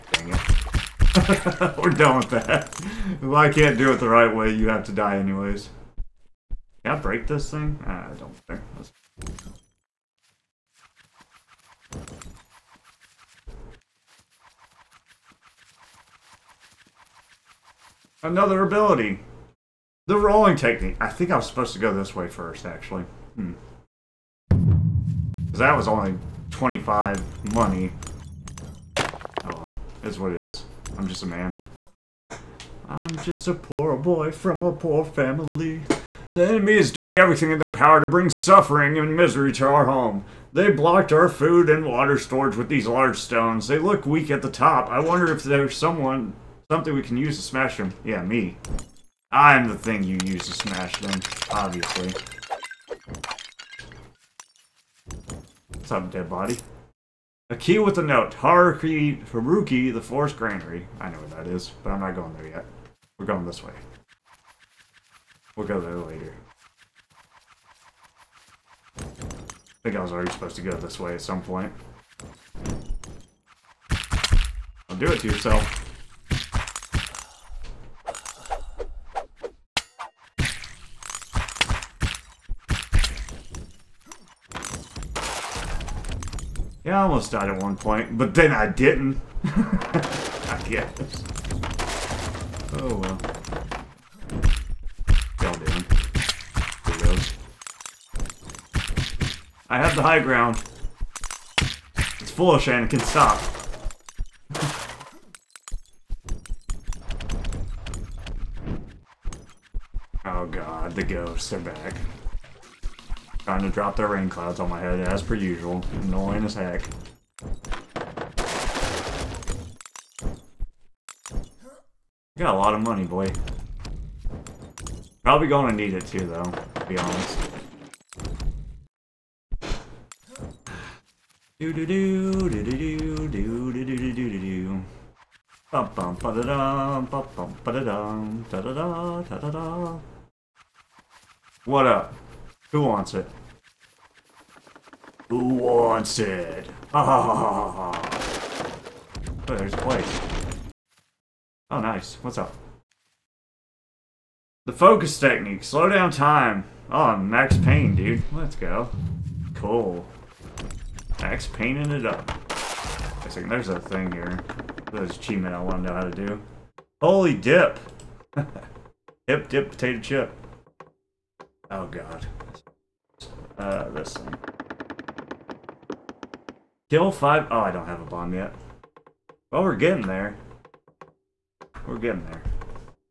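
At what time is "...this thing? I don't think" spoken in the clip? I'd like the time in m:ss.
0:07.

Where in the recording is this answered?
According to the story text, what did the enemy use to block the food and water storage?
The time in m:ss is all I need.
0:42.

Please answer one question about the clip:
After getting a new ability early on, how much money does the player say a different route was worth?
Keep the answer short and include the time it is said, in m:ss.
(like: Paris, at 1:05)
25, at 0:26.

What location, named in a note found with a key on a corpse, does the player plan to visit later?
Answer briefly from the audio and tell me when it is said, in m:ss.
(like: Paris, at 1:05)
the Forest Granary, at 0:59.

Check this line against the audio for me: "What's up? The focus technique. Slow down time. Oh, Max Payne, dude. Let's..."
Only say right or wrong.
right.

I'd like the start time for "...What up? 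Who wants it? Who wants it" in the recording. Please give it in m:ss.
2:21.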